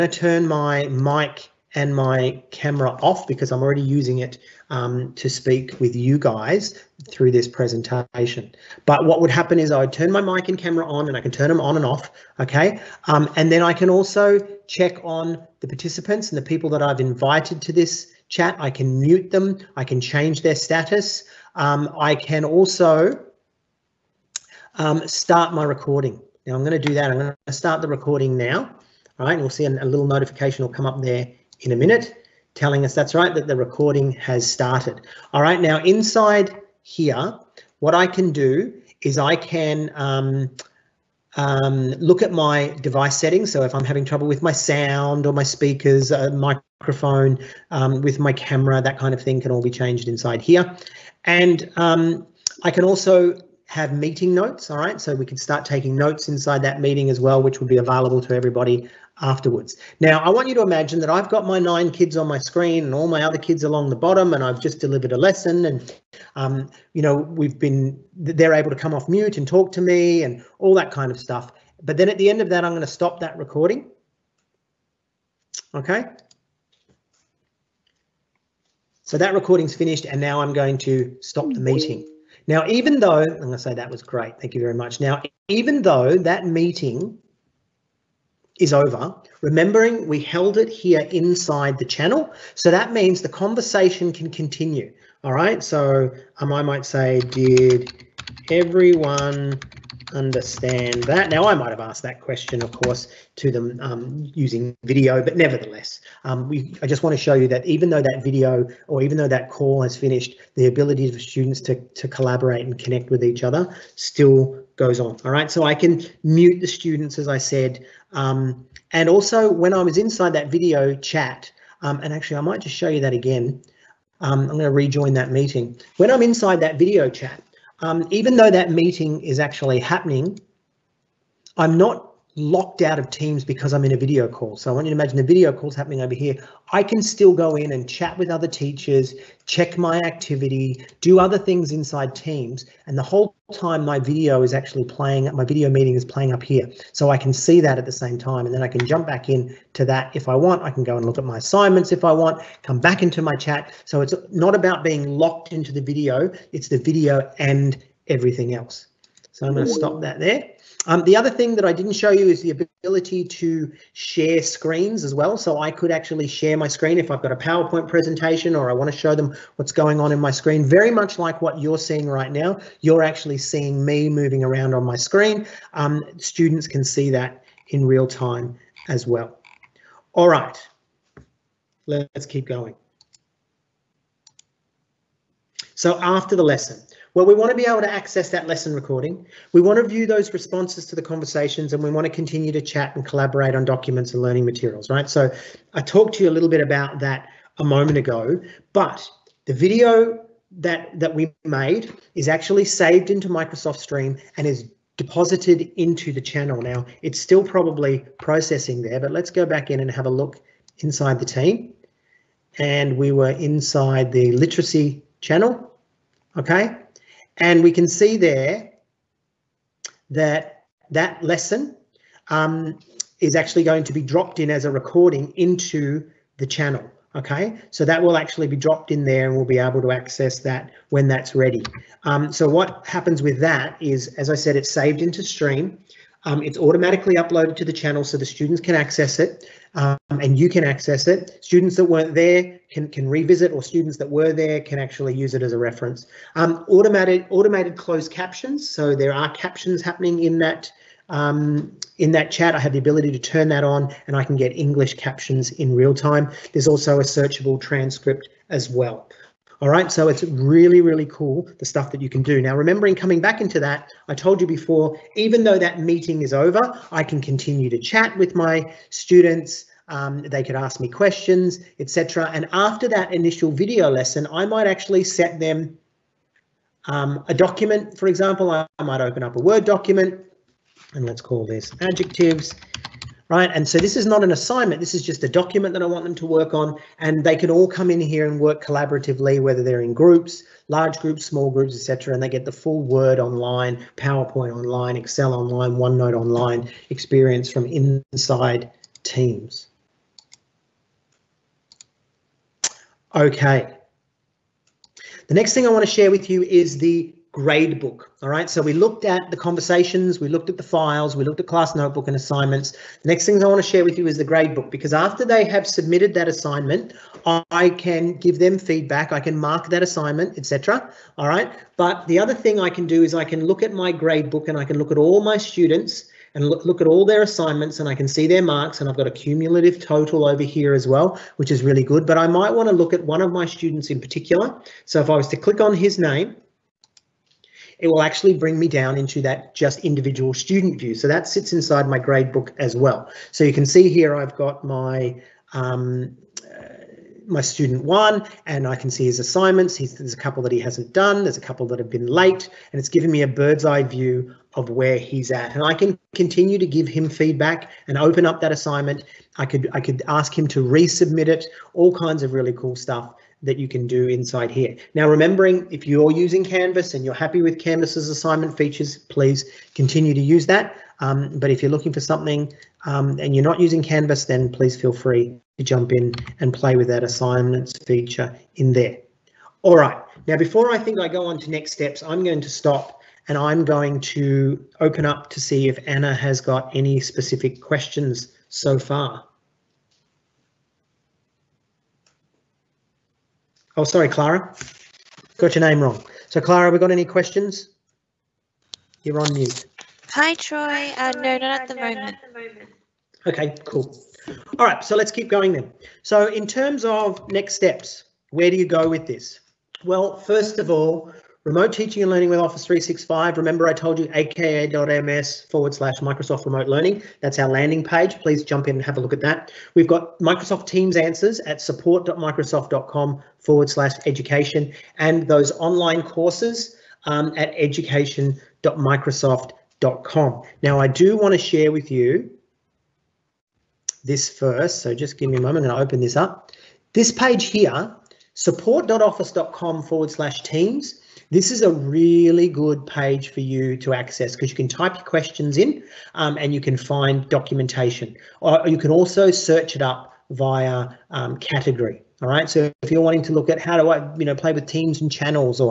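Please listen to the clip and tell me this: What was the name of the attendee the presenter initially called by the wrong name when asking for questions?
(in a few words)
Anna.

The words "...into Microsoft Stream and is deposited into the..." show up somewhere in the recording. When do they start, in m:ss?
3:23.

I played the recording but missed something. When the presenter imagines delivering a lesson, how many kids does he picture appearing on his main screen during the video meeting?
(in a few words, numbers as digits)
9.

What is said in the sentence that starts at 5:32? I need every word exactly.
But I might want to look at one of my students in particular.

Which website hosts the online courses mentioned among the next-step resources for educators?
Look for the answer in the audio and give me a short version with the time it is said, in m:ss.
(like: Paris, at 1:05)
education.microsoft.com, at 7:07.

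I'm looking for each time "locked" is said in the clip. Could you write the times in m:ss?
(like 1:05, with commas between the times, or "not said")
2:12, 2:35.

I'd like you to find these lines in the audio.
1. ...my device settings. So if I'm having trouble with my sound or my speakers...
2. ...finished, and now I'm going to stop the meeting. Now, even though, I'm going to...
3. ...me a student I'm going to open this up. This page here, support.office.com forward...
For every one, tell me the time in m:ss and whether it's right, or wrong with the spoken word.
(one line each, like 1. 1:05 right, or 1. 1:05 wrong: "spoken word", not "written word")
1. 0:42 right
2. 1:19 right
3. 7:15 wrong: "moment", not "student".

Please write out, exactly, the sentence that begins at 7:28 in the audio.
Or you can also search it up via um, category.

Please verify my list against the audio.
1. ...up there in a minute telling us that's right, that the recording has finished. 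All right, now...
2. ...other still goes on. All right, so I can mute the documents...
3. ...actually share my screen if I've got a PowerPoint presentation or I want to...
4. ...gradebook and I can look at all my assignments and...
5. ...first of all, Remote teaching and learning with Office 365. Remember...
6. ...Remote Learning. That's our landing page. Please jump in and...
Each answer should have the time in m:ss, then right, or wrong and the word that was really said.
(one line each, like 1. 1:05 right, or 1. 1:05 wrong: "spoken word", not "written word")
1. 0:30 wrong: "started", not "finished"
2. 1:53 wrong: "students", not "documents"
3. 2:45 right
4. 5:23 wrong: "students", not "assignments"
5. 6:50 right
6. 6:56 right.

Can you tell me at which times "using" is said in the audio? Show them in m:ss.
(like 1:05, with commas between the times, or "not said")
0:03, 1:44, 6:06, 6:13.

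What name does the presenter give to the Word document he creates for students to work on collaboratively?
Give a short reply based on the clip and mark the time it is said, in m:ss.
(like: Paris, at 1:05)
adjectives, at 4:41.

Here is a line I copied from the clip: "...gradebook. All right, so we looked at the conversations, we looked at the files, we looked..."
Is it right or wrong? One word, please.
right.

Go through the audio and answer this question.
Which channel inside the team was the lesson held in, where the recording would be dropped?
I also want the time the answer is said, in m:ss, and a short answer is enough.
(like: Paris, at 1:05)
literacy, at 3:34.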